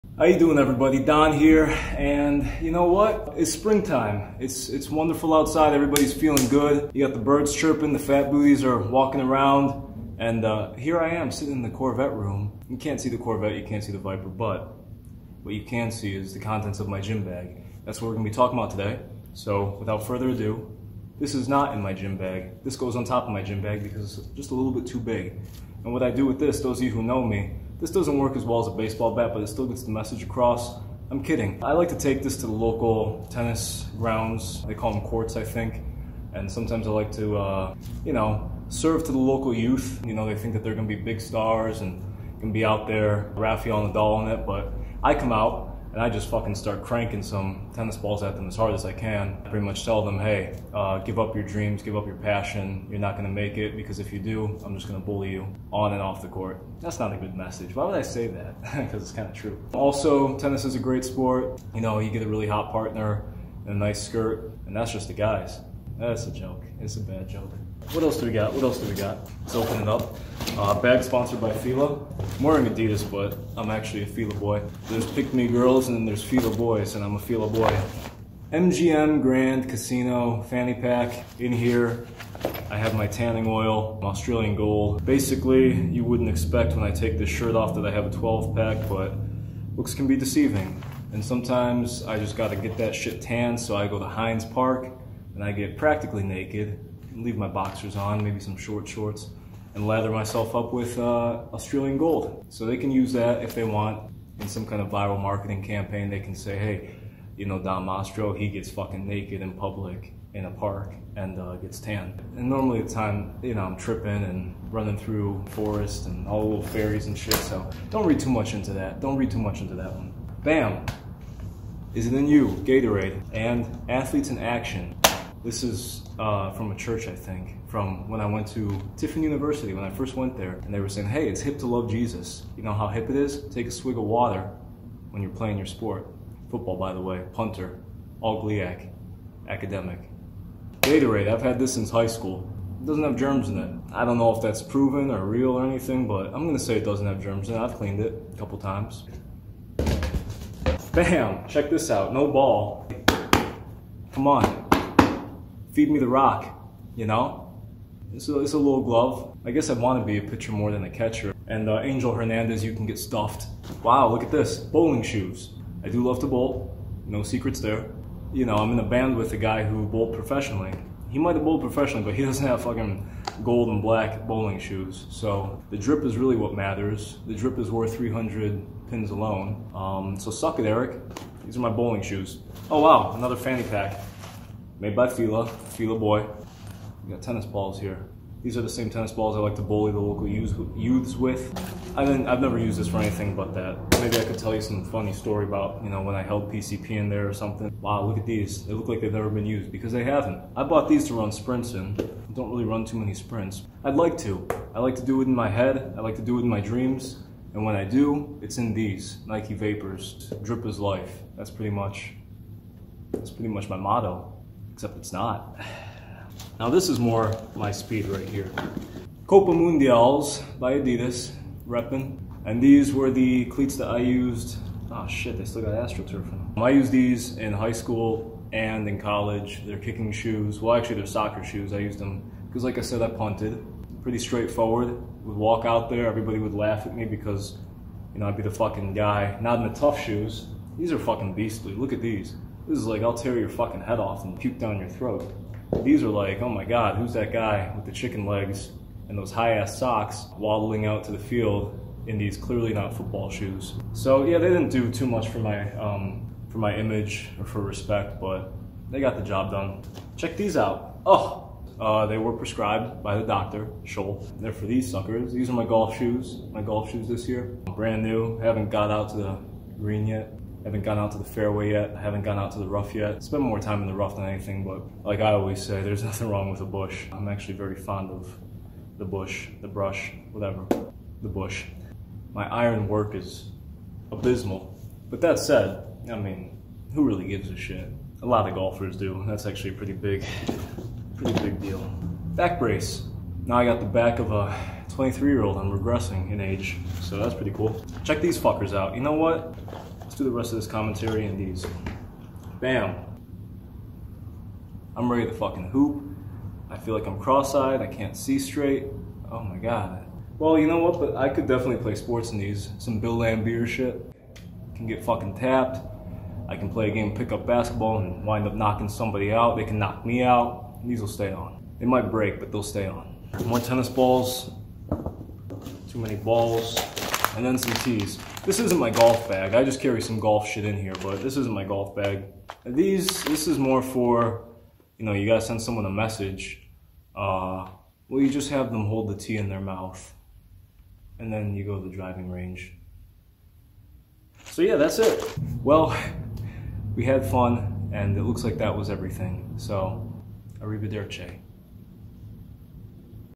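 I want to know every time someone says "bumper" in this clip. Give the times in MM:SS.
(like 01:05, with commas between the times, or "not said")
not said.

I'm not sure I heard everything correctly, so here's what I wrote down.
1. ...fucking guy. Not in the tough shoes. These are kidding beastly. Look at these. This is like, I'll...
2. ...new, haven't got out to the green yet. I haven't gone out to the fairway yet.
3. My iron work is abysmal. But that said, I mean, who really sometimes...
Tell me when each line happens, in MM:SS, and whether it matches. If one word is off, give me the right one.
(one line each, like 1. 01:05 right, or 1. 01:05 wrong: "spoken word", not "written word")
1. 03:58 wrong: "fucking", not "kidding"
2. 04:28 right
3. 04:42 wrong: "gives", not "sometimes".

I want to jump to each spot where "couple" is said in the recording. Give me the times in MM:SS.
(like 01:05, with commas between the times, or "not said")
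02:28.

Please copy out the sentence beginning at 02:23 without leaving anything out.
I don't know if that's proven or real or anything, but I'm gonna say it doesn't have germs in it.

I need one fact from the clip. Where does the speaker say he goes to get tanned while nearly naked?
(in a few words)
Heinz Park.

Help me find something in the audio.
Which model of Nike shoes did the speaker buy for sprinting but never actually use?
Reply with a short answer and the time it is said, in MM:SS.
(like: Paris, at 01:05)
Nike Vapors, at 03:29.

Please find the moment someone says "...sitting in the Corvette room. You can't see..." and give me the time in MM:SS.
00:11.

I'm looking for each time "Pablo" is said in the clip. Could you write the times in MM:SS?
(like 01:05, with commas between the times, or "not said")
not said.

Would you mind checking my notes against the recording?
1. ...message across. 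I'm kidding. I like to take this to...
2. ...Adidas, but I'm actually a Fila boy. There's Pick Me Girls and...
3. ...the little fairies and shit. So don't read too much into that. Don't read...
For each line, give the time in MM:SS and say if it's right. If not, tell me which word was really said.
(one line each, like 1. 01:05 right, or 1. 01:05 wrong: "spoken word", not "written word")
1. 00:29 right
2. 01:12 right
3. 01:56 right.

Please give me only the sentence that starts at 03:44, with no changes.
Oh shit, they still got AstroTurf in them.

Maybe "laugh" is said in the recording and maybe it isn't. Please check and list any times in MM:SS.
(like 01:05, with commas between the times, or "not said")
03:56.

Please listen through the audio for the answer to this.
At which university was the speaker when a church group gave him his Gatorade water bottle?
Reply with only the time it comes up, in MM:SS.
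02:08.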